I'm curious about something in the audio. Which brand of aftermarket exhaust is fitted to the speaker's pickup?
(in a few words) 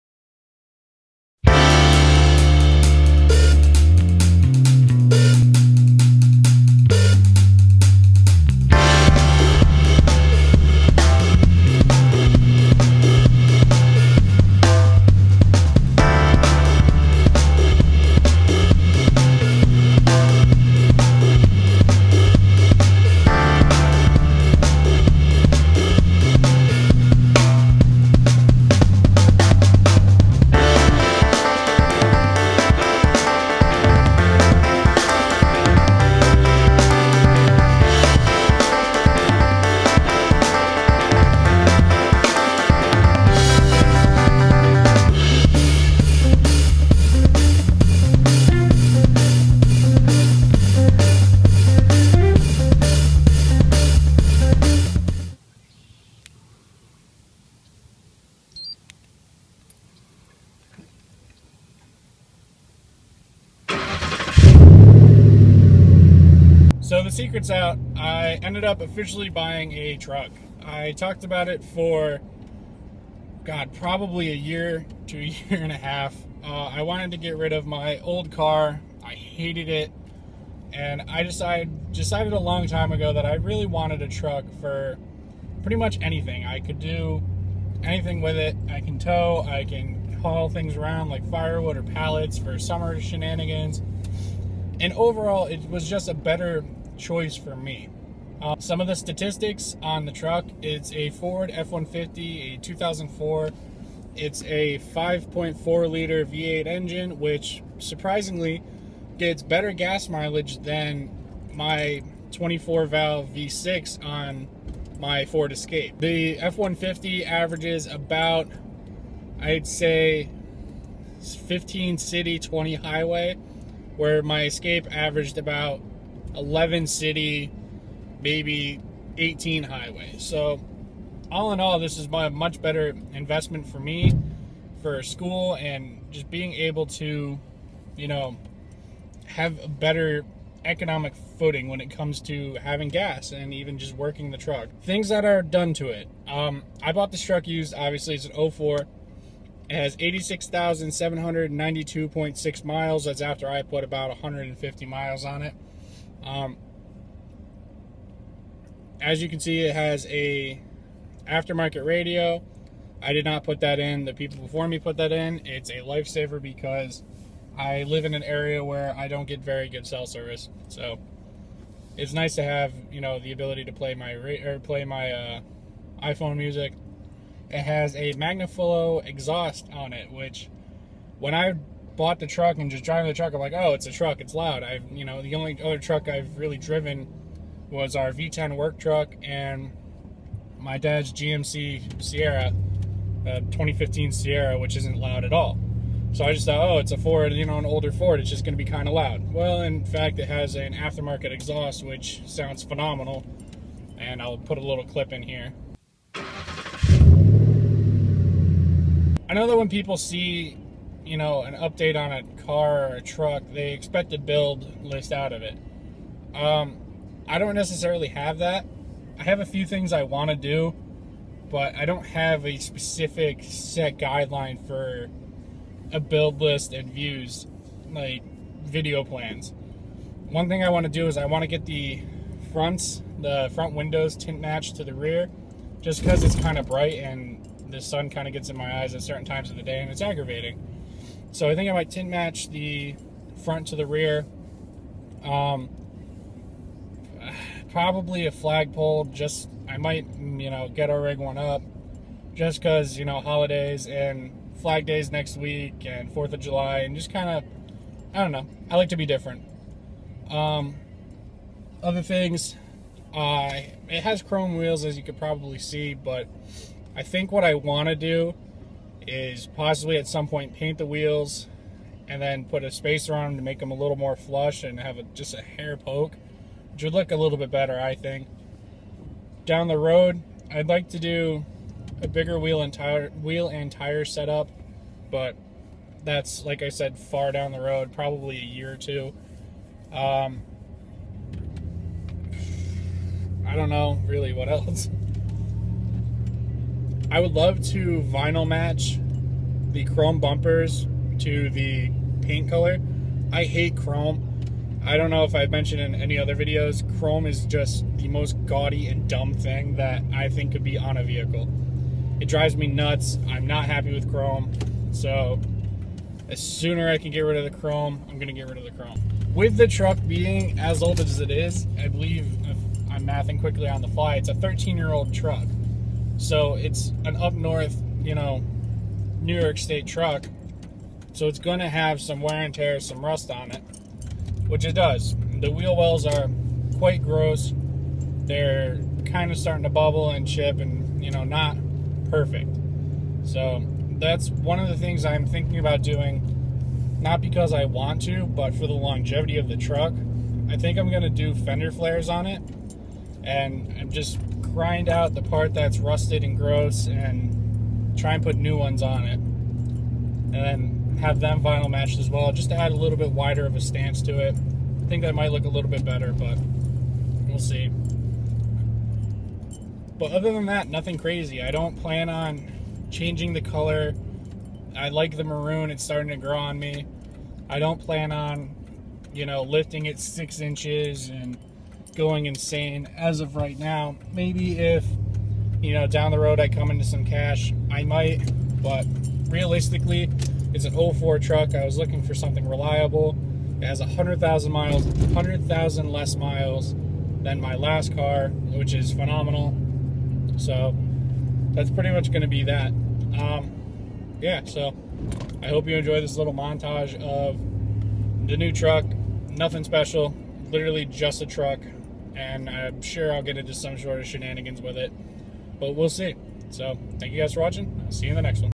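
Magnaflow.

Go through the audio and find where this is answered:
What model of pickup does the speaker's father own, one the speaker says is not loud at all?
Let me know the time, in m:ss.
3:11.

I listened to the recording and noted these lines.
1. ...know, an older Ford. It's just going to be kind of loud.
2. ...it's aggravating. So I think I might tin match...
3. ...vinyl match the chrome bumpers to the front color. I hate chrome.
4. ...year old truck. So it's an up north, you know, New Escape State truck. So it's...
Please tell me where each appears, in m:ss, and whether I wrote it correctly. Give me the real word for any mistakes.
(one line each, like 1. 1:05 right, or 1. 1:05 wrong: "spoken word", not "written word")
1. 3:17 right
2. 3:59 right
3. 4:58 wrong: "paint", not "front"
4. 5:24 wrong: "York", not "Escape".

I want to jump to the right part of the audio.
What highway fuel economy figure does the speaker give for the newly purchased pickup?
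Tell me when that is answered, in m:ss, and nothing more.
2:02.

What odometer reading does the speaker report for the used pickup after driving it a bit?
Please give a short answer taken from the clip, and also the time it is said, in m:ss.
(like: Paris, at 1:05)
86,792.6 miles, at 2:29.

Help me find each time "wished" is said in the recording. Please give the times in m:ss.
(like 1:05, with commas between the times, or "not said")
not said.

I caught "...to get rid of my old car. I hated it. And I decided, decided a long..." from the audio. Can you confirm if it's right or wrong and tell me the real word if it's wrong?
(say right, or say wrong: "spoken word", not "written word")
right.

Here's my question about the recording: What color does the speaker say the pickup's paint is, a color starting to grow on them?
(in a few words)
maroon.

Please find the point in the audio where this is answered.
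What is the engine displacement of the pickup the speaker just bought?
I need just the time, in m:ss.
1:44.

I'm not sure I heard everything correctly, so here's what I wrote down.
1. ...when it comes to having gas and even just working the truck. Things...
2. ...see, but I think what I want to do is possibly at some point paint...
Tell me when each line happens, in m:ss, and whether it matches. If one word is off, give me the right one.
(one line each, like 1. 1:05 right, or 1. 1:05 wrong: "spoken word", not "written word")
1. 2:21 right
2. 4:25 right.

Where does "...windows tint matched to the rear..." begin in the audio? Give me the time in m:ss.
3:53.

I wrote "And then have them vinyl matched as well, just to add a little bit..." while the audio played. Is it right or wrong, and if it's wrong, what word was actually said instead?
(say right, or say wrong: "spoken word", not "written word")
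right.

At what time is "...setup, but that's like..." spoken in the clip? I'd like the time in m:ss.
4:44.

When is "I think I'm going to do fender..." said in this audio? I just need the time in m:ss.
5:50.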